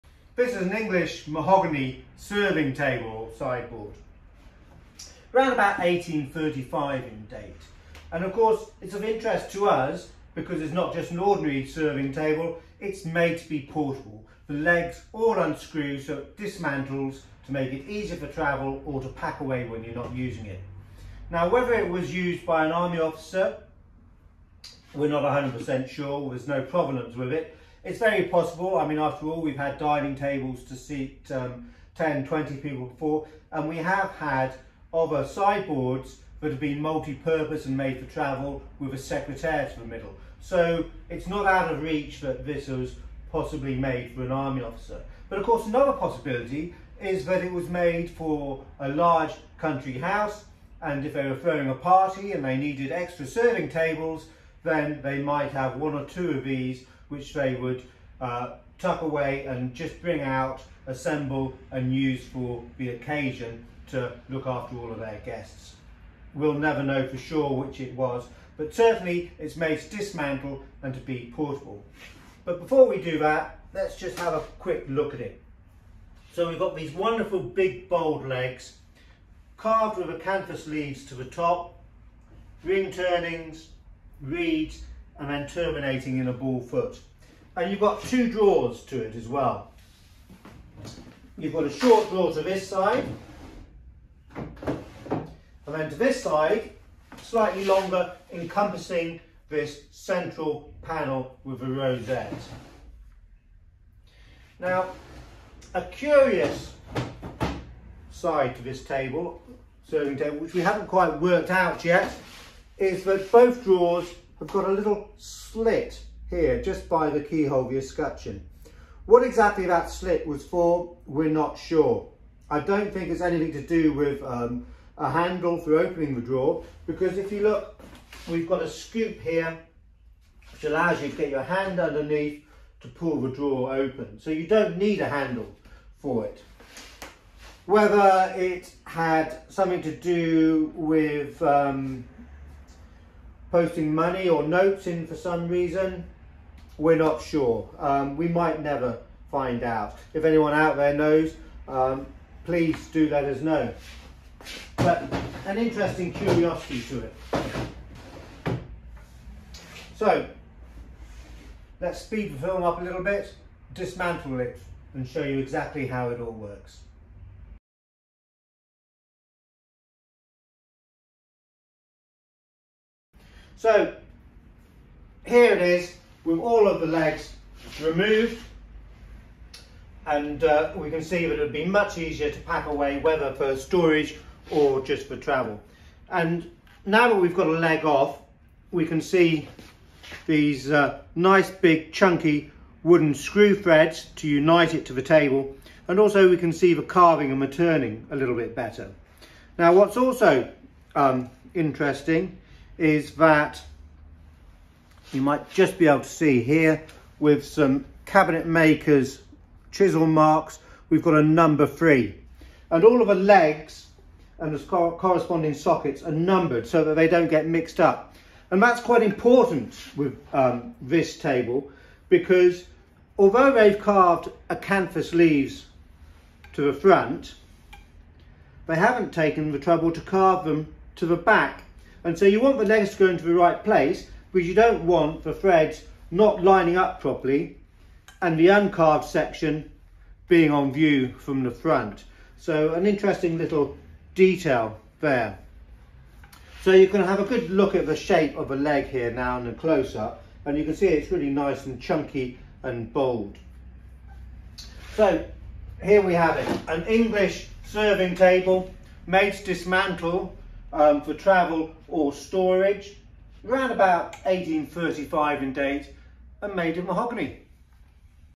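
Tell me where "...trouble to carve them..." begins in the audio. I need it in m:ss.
3:49.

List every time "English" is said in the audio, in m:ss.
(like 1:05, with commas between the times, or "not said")
0:00, 4:16.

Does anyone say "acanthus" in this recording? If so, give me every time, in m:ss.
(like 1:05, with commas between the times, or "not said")
1:20, 3:44.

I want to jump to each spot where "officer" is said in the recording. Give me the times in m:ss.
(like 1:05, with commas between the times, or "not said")
0:22, 0:44.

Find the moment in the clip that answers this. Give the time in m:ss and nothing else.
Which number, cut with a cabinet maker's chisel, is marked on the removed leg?
3:31.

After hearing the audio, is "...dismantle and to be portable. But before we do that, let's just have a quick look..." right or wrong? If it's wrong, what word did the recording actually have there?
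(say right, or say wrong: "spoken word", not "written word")
right.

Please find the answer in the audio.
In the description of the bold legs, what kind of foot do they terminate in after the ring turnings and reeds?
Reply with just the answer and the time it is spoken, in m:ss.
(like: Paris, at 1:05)
ball foot, at 1:26.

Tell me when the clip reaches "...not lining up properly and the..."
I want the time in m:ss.
3:56.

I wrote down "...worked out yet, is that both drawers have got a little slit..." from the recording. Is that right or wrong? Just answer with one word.
right.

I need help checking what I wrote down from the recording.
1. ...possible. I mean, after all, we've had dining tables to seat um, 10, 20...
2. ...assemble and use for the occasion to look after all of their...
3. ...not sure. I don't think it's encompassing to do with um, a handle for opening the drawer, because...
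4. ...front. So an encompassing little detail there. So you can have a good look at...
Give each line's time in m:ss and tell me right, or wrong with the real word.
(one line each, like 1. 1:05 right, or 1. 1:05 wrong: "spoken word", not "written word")
1. 0:28 right
2. 1:00 right
3. 2:01 wrong: "anything", not "encompassing"
4. 4:01 wrong: "interesting", not "encompassing".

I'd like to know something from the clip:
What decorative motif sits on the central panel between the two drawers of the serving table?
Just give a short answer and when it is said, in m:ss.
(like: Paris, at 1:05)
rosette, at 1:41.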